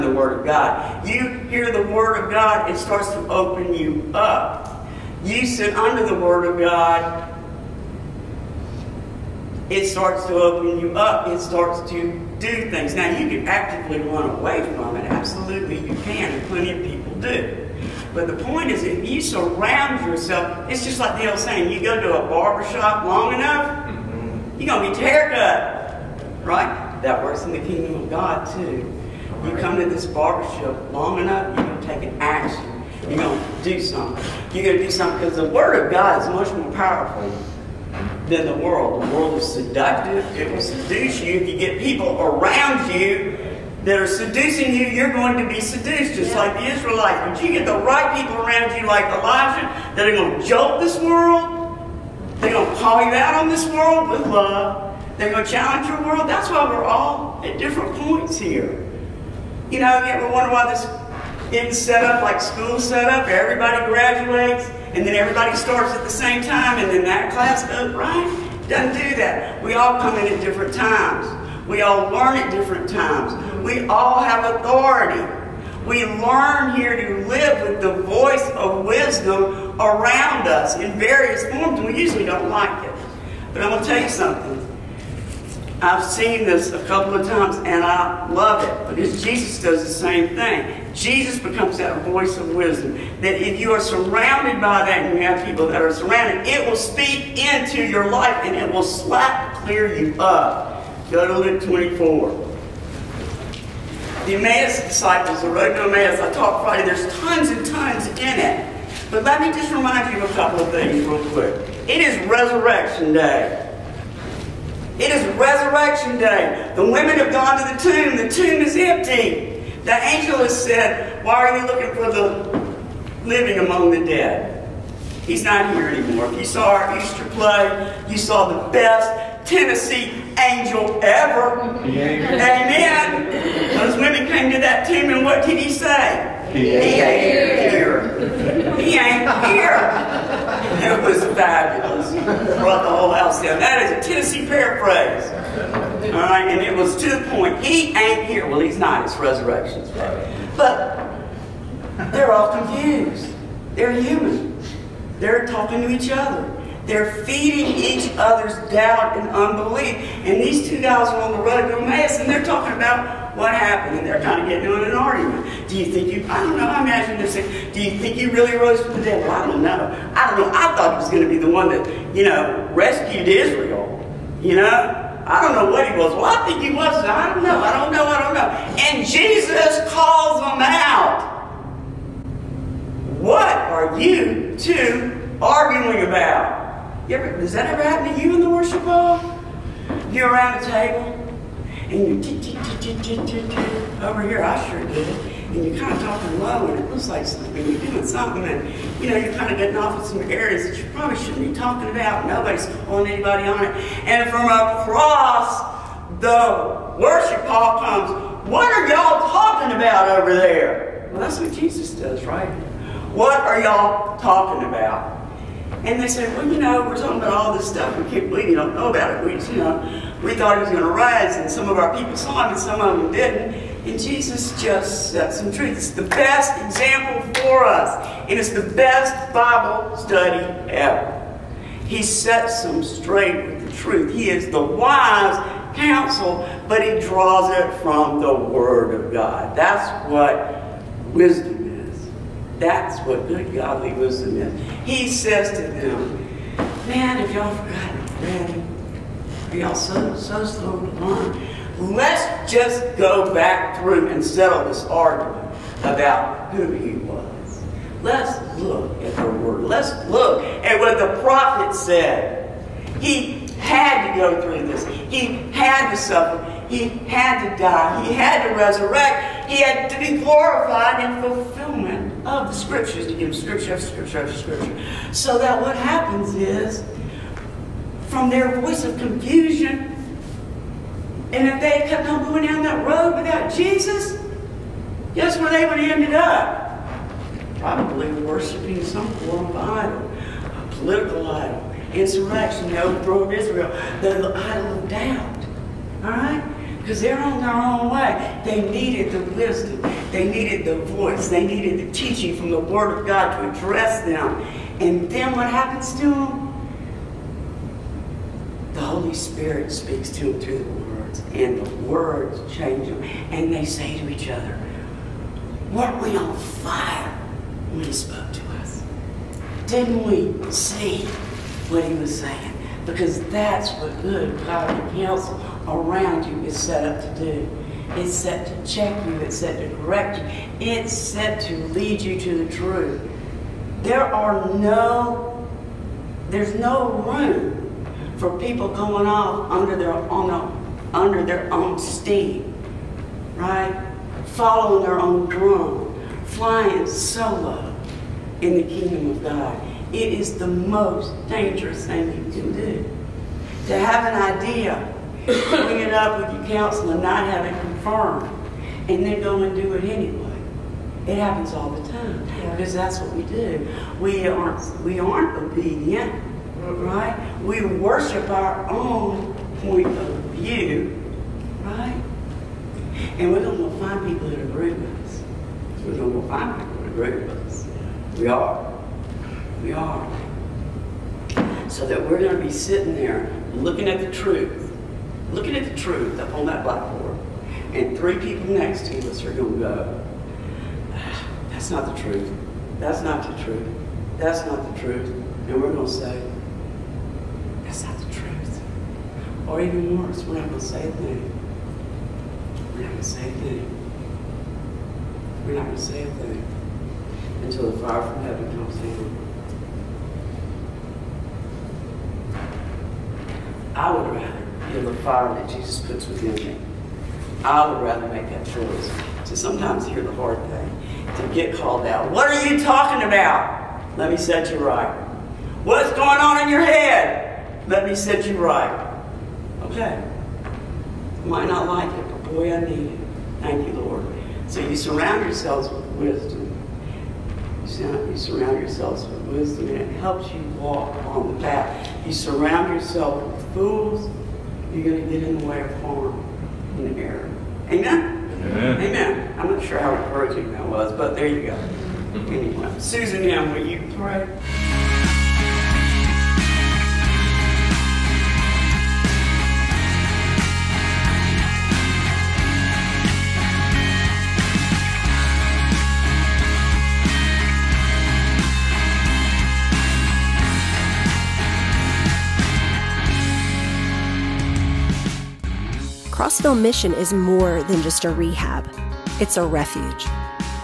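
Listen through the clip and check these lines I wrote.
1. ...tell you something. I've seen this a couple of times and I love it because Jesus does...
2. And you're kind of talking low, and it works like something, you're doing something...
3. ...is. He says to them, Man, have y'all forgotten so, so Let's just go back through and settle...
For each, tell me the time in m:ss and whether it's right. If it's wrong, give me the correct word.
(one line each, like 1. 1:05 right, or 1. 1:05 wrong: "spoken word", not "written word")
1. 1:23 right
2. 3:15 wrong: "looks", not "works"
3. 4:04 right.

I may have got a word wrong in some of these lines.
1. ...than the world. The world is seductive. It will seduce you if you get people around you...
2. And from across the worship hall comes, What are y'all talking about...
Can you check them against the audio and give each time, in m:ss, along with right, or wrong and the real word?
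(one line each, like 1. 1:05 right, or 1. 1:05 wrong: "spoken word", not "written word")
1. 0:38 right
2. 3:24 right.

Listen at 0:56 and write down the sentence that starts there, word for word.
That's why we're all at different points here.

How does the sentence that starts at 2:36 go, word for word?
They're feeding each other's doubt and unbelief.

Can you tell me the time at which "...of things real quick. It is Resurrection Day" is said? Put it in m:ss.
1:50.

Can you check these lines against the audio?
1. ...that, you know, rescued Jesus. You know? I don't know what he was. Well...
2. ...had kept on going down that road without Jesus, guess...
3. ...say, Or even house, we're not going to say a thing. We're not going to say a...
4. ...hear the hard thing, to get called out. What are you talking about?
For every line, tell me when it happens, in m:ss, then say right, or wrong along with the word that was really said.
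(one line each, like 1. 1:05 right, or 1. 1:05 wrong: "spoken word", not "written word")
1. 2:51 wrong: "Israel", not "Jesus"
2. 4:41 right
3. 6:35 wrong: "worse", not "house"
4. 6:59 right.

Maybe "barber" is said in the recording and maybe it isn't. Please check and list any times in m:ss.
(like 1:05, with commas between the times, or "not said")
0:22, 0:30.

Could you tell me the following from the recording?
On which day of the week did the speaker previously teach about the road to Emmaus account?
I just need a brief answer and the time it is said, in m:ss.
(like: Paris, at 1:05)
Friday, at 1:46.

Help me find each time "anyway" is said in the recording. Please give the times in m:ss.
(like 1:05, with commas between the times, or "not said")
5:59, 7:32.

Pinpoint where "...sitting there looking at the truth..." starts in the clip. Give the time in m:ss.
6:22.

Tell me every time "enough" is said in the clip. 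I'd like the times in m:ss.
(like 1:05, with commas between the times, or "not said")
0:23, 0:31.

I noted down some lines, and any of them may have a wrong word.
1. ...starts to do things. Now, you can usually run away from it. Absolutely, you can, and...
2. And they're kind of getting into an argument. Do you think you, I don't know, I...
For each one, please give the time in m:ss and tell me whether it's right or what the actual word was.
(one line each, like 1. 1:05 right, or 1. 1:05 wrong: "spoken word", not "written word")
1. 0:11 wrong: "actively", not "usually"
2. 2:43 right.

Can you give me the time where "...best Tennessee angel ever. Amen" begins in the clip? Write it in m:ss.
2:08.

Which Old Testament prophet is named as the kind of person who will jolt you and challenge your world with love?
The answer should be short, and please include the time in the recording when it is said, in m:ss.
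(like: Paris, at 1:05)
Elijah, at 0:49.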